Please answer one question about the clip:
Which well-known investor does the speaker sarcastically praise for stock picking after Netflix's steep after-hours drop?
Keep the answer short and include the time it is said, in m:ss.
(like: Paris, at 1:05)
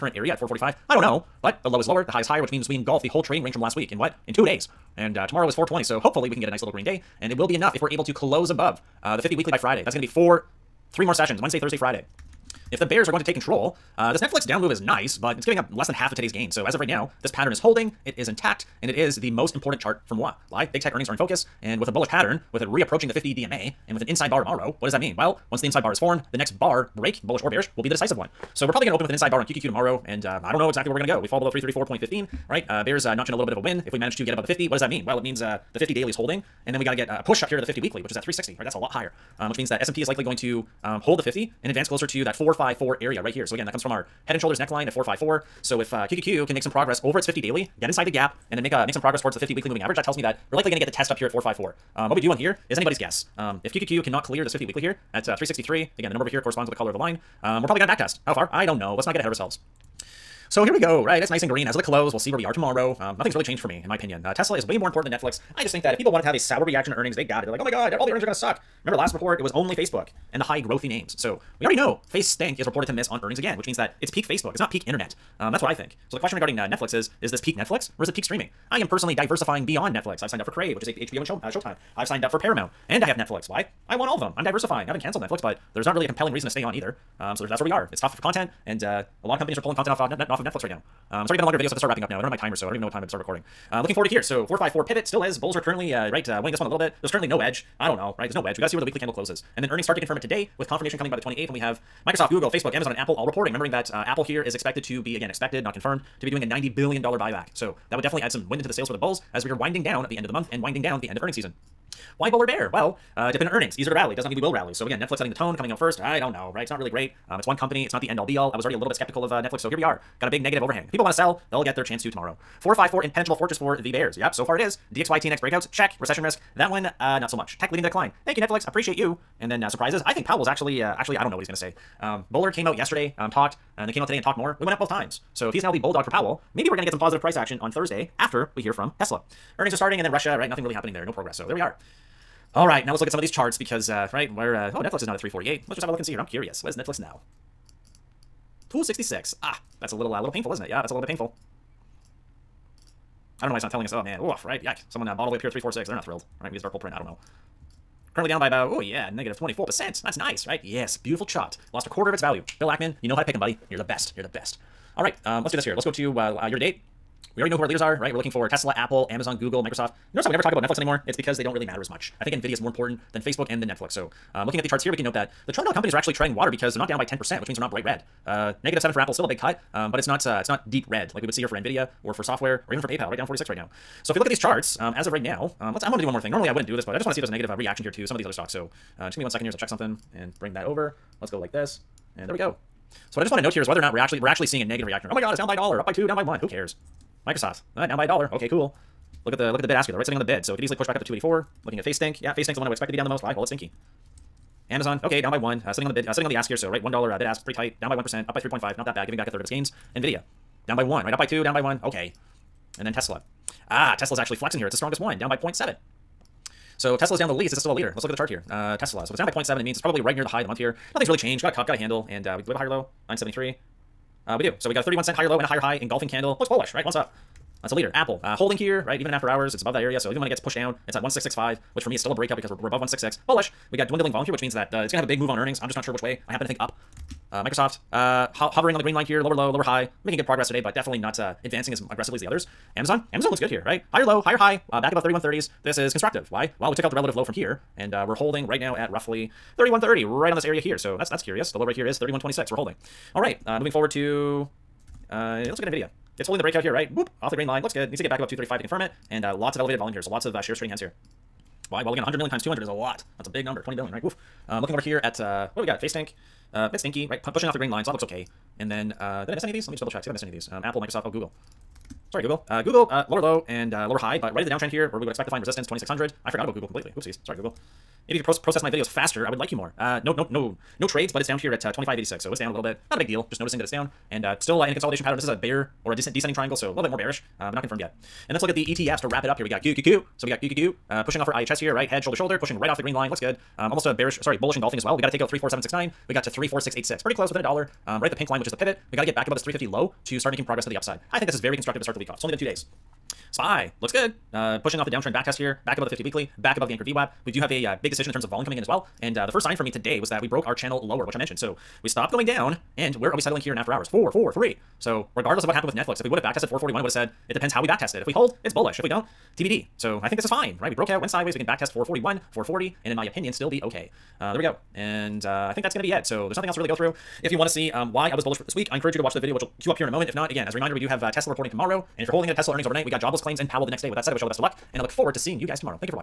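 Bill Ackman, at 2:42.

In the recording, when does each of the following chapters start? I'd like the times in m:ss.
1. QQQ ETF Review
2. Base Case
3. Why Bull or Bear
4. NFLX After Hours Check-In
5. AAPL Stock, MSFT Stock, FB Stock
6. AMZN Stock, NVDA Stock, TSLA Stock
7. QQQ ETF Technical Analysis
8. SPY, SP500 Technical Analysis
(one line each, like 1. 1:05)
1. 0:13
2. 1:18
3. 1:52
4. 2:28
5. 3:09
6. 3:25
7. 4:48
8. 4:58.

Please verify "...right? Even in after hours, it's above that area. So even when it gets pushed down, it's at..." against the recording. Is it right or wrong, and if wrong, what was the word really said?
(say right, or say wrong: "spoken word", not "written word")
right.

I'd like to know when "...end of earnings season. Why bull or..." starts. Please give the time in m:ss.
1:51.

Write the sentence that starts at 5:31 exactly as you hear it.
And if you're holding it at Tesla earnings overnight, we got jobless claims and Powell the next day.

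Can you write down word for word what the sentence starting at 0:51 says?
Um, what we do on here is anybody's guess.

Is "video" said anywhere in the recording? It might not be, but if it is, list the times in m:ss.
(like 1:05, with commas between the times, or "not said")
1:31, 4:38, 5:29.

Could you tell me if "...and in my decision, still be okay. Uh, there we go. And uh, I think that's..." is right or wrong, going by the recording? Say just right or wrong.
wrong.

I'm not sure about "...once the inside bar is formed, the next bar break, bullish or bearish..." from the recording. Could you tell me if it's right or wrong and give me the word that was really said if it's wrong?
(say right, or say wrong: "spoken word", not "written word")
right.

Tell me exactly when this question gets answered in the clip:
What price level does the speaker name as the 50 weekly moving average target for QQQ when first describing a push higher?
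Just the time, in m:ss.
0:38.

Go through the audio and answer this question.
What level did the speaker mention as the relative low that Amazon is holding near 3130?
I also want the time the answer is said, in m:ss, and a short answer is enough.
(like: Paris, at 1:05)
3126, at 4:11.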